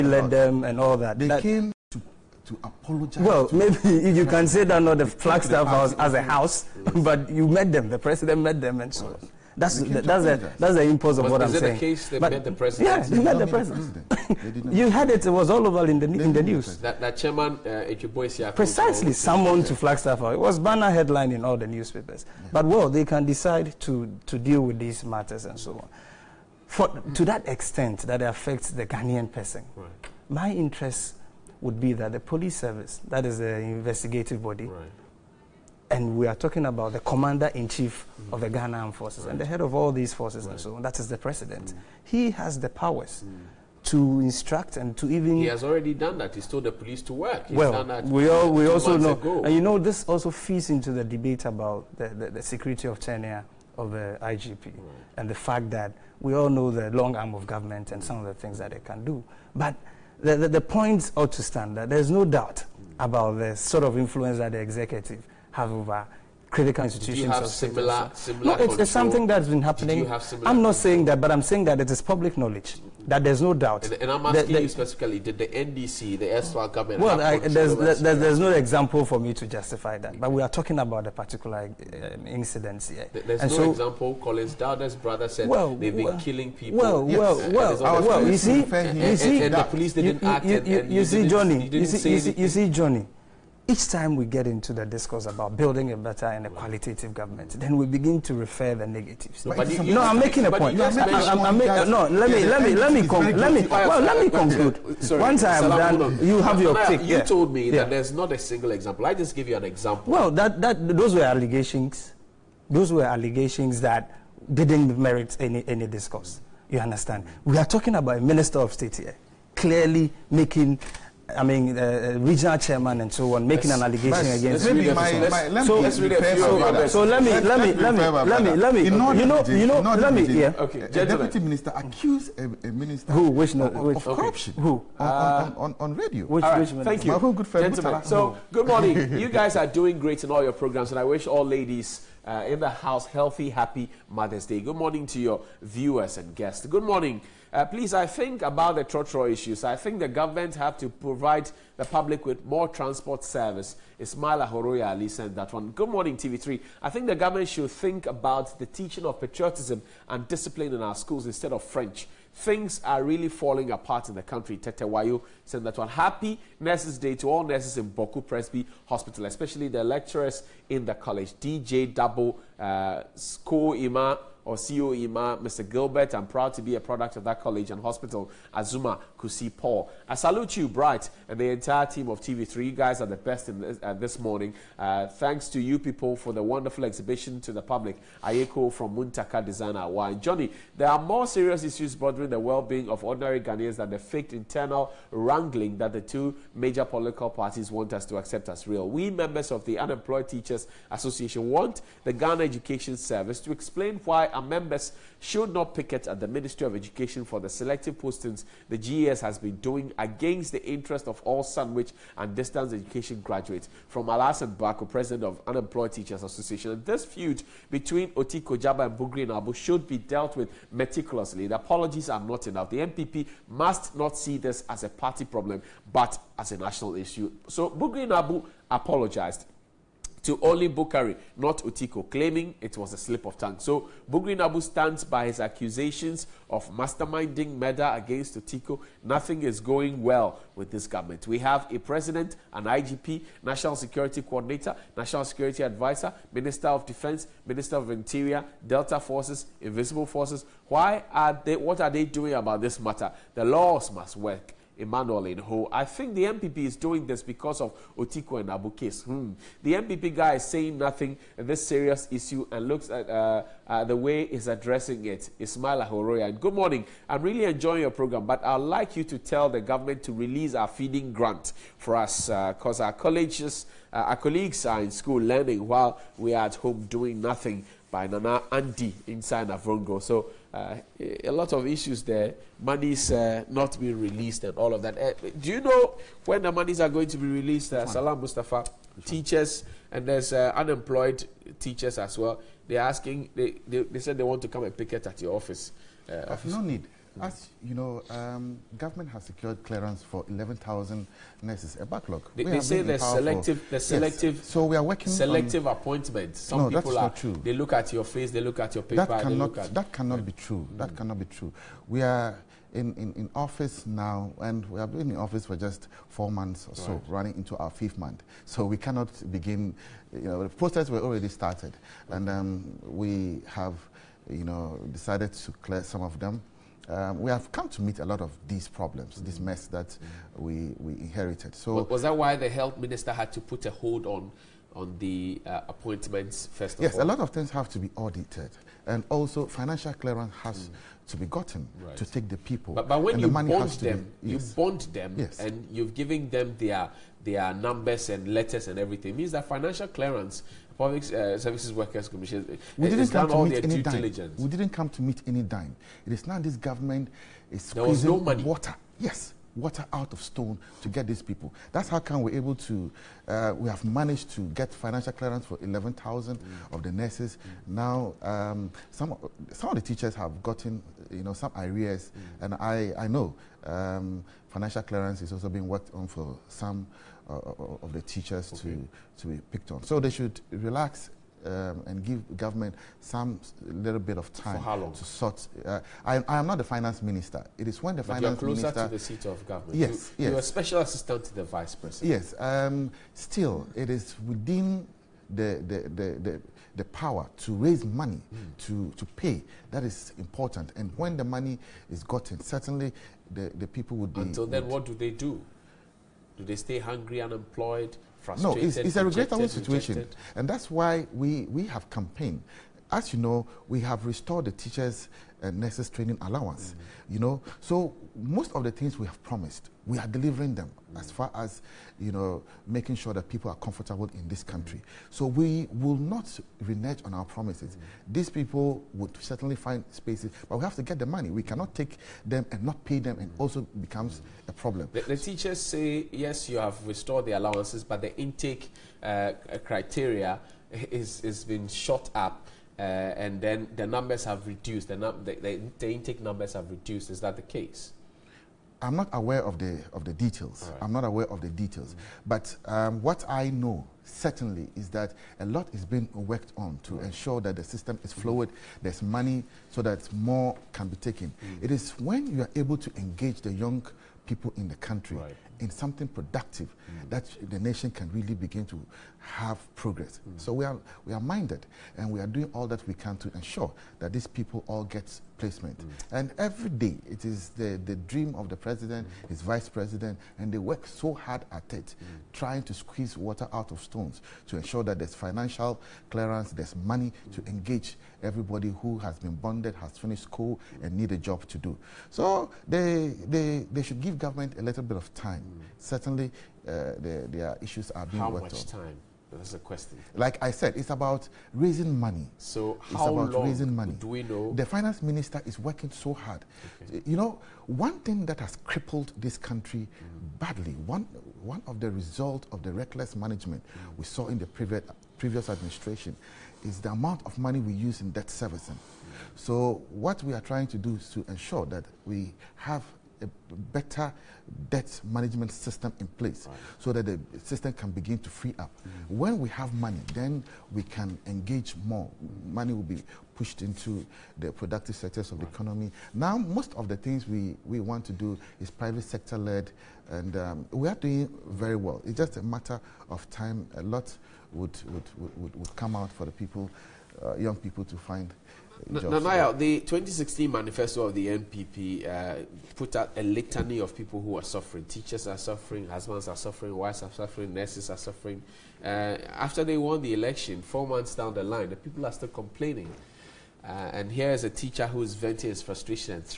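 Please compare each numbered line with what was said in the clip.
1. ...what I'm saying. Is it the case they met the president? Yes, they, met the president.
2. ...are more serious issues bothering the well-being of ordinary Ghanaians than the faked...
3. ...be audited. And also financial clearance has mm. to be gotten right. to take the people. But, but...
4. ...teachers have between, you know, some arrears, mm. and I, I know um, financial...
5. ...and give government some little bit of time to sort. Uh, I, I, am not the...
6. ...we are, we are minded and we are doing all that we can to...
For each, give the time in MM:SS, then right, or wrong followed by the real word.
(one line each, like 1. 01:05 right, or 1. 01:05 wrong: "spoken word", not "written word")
1. 00:11 right
2. 03:10 right
3. 05:37 right
4. 06:09 wrong: "gotten", not "between"
5. 06:21 right
6. 07:50 right.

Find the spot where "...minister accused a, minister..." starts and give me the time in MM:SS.
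02:11.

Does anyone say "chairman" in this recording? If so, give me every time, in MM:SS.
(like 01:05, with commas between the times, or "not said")
00:17, 02:02.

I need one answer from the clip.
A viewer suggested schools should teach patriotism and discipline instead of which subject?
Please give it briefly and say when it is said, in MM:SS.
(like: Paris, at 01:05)
French, at 02:41.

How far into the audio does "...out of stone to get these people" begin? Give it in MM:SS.
05:59.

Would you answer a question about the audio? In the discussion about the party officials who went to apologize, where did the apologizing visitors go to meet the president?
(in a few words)
Flagstaff House.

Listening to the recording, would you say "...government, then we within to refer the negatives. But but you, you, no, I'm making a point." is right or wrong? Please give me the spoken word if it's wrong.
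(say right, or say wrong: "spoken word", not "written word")
wrong: "begin", not "within".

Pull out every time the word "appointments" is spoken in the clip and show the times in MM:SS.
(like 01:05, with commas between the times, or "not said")
05:05, 05:35.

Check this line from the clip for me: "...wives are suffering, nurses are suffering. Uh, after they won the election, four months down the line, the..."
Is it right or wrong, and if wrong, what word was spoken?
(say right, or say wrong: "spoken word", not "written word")
right.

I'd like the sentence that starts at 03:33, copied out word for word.
From Alasan Bako, president of Unemployed Teachers Association, this feud between Otiko Djaba and Bugri Naabu should be dealt with meticulously.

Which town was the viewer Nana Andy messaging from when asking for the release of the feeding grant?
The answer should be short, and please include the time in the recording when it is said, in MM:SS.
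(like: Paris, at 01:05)
Navrongo, at 04:39.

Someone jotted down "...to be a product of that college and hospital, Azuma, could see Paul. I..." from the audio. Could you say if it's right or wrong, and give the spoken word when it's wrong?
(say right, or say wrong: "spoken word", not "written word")
right.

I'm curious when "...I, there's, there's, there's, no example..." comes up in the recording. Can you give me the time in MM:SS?
01:17.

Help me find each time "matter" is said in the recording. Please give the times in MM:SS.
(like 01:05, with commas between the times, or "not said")
00:25, 04:12, 09:02.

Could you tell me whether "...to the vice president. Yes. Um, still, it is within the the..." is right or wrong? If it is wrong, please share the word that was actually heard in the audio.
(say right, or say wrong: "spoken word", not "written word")
right.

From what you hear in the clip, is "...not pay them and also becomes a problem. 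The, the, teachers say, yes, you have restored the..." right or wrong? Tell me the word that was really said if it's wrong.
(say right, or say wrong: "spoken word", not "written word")
right.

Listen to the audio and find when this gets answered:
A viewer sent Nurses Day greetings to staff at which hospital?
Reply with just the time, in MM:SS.
02:47.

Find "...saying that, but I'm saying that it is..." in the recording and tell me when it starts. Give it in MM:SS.
01:10.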